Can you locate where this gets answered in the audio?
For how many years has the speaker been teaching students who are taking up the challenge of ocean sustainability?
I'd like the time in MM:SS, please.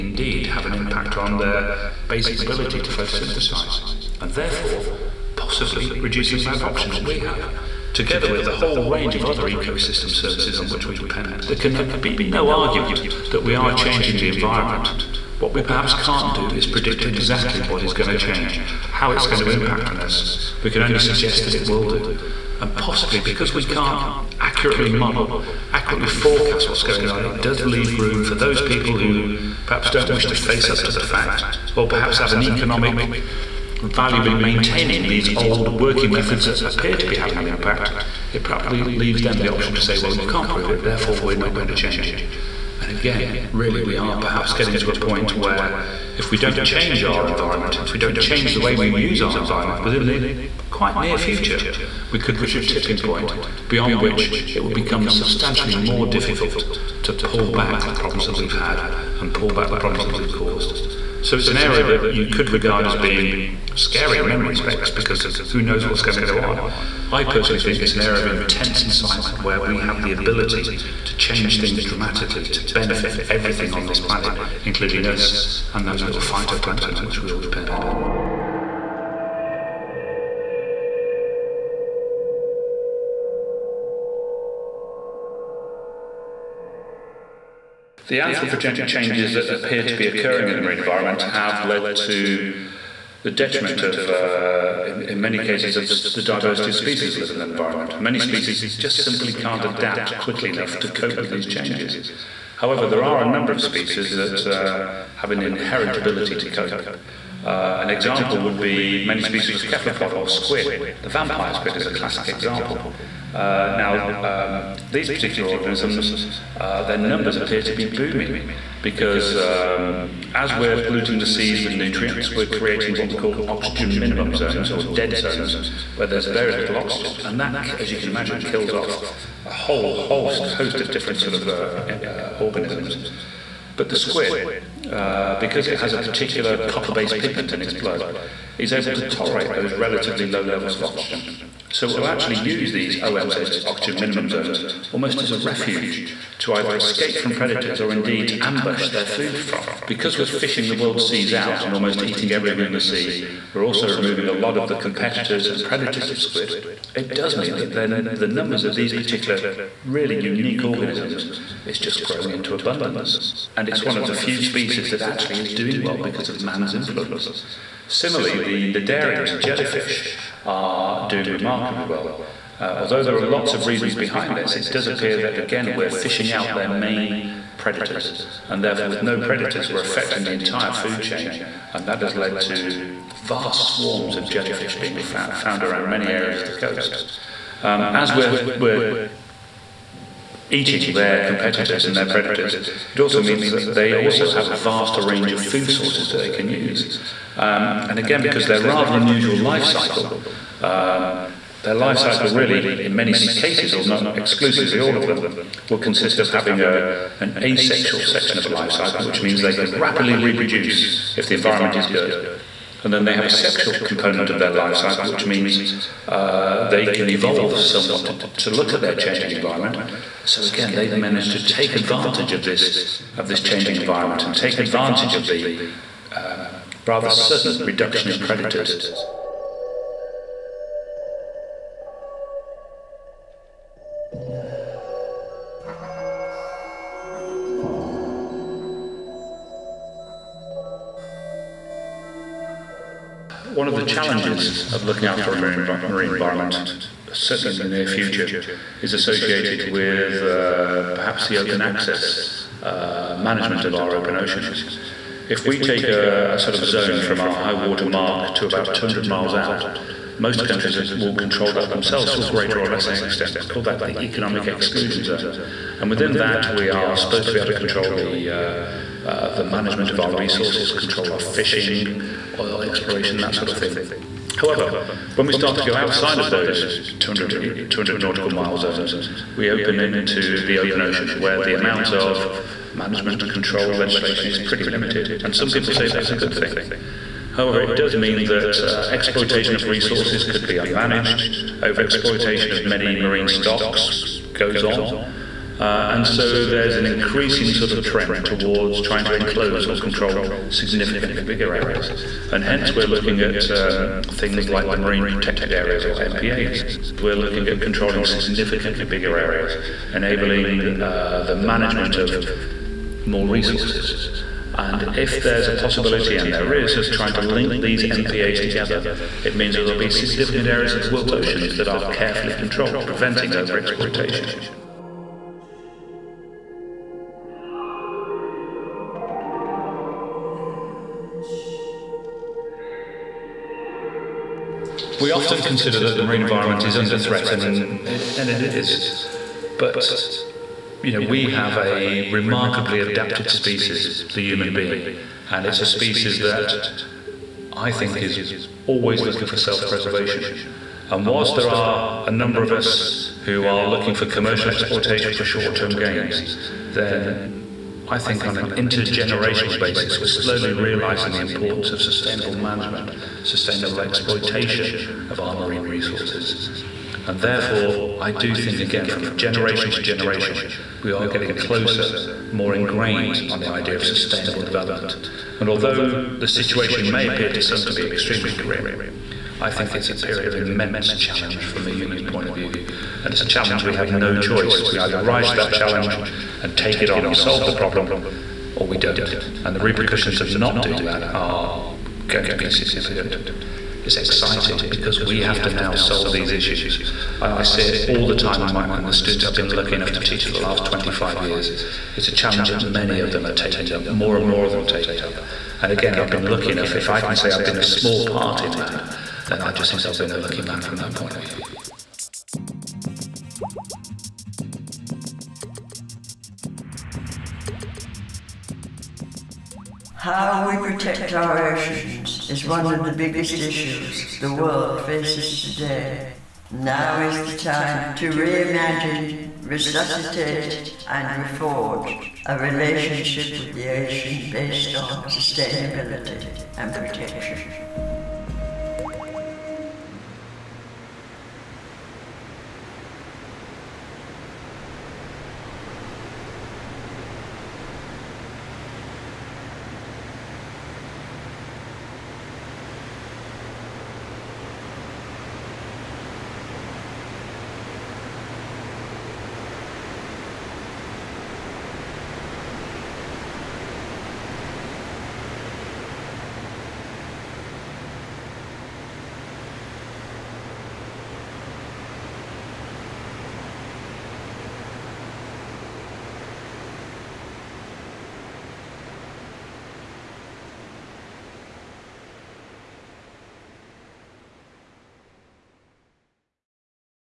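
06:40.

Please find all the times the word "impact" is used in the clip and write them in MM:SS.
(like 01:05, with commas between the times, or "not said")
00:00, 00:19, 00:37.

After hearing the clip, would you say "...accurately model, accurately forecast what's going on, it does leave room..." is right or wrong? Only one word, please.
right.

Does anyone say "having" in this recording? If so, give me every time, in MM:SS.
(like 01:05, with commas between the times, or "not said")
00:37, 03:26.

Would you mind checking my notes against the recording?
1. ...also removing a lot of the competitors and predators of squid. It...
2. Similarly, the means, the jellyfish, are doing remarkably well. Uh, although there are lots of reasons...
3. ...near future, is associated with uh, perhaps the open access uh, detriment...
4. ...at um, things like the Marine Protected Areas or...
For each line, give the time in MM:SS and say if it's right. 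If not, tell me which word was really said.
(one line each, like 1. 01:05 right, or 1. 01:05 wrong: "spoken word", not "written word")
1. 02:33 right
2. 02:47 wrong: "cnidarians", not "means"
3. 04:07 wrong: "management", not "detriment"
4. 05:03 right.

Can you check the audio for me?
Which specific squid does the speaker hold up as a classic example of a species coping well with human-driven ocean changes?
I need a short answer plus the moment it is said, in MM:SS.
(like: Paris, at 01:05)
vampire squid, at 01:51.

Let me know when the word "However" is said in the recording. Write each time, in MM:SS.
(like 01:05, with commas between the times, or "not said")
01:42, 04:34, 04:47.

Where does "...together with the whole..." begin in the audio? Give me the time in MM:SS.
00:07.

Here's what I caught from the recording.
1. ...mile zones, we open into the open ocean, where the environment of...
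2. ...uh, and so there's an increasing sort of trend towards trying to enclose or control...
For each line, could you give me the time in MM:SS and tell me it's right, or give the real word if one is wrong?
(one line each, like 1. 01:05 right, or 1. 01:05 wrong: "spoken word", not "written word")
1. 04:38 wrong: "amount", not "environment"
2. 04:55 right.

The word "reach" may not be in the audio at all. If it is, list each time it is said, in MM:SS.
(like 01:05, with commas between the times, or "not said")
00:52.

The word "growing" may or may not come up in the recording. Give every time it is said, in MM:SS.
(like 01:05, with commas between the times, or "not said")
02:42.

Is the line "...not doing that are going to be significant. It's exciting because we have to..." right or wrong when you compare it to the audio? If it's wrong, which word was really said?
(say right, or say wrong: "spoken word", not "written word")
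right.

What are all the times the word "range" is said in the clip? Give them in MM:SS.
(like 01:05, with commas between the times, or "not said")
00:08, 03:15.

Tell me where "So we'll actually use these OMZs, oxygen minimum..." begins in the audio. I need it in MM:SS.
02:21.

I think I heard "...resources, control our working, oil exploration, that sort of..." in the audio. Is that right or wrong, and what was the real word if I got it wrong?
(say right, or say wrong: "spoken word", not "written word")
wrong: "fishing", not "working".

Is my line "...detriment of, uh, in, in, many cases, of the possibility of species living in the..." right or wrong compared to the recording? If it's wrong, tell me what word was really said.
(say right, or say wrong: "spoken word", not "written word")
wrong: "diversity", not "possibility".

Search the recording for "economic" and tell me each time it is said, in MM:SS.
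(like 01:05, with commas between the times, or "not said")
00:32, 04:24.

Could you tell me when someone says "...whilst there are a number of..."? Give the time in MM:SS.
05:51.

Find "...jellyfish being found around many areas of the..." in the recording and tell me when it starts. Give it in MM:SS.
03:04.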